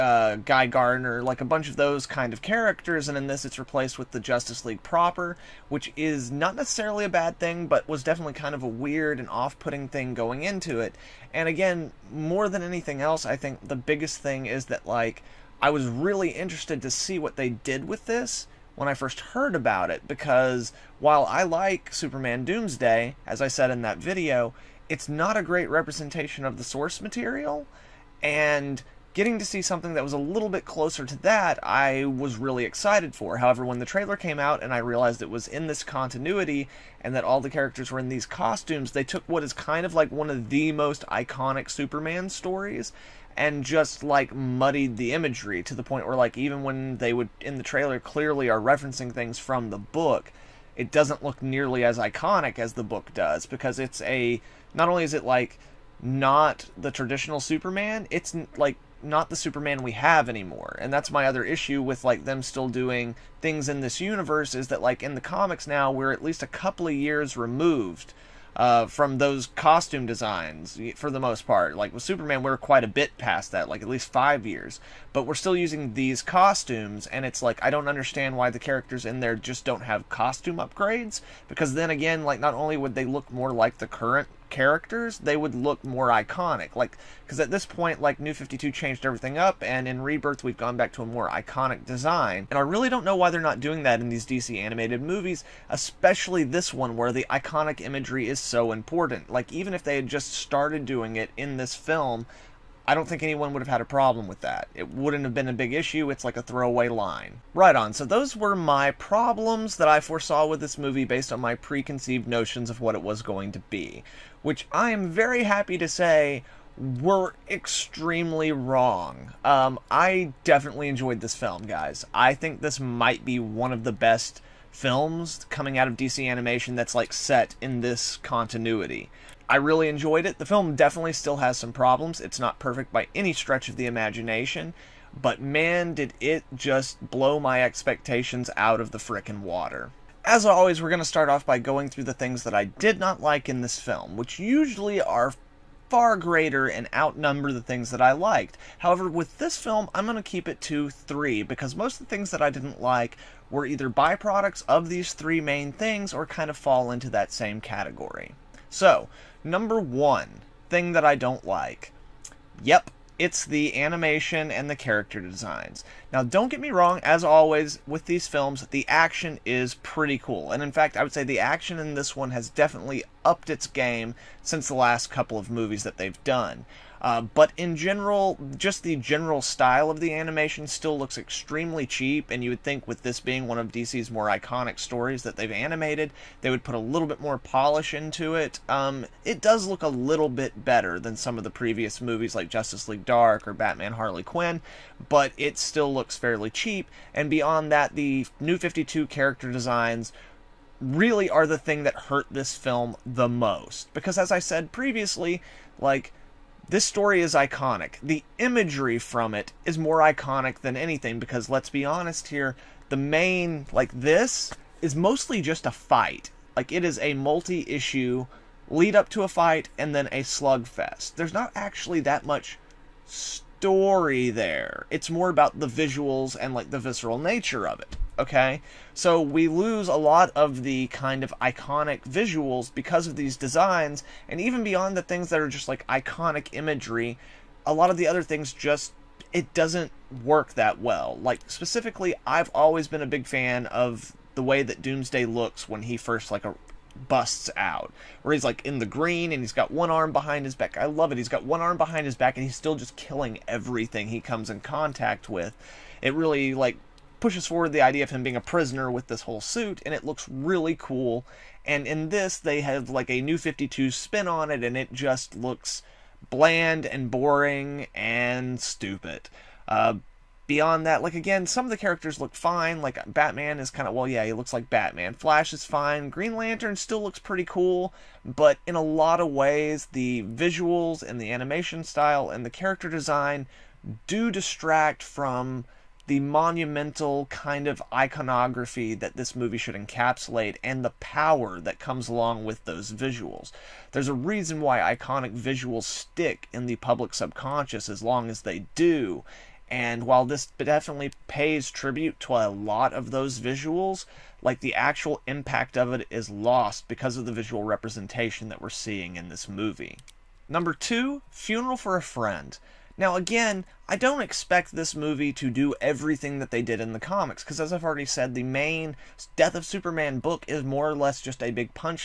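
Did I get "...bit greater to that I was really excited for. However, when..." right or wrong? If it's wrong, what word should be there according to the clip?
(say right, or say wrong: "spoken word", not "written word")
wrong: "closer", not "greater".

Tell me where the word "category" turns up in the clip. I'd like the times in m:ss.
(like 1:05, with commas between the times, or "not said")
2:37.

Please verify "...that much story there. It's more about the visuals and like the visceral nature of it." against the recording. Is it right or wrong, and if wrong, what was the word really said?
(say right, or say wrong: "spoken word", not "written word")
right.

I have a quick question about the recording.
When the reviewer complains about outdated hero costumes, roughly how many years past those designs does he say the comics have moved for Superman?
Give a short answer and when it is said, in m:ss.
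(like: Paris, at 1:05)
5, at 1:14.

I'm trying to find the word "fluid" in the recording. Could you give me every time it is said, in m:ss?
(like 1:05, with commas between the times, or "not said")
not said.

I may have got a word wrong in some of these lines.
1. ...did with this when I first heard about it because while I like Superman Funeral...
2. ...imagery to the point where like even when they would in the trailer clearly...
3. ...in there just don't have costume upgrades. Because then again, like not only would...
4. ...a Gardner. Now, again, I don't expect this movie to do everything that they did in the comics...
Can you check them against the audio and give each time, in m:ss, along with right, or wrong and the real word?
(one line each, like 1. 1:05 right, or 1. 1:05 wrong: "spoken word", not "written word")
1. 0:17 wrong: "Doomsday", not "Funeral"
2. 0:45 right
3. 1:19 right
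4. 5:11 wrong: "Friend", not "Gardner".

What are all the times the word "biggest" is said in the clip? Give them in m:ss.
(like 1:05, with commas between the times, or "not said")
0:13.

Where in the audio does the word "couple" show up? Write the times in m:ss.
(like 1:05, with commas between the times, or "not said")
1:06, 2:55.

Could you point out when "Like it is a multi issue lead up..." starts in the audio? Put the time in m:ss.
3:36.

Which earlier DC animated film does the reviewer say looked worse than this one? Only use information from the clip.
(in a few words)
Justice League Dark.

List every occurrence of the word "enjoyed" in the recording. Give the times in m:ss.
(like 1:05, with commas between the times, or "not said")
2:00, 2:09.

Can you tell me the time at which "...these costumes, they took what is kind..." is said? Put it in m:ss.
0:38.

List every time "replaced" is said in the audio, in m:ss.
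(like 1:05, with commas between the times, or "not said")
0:03.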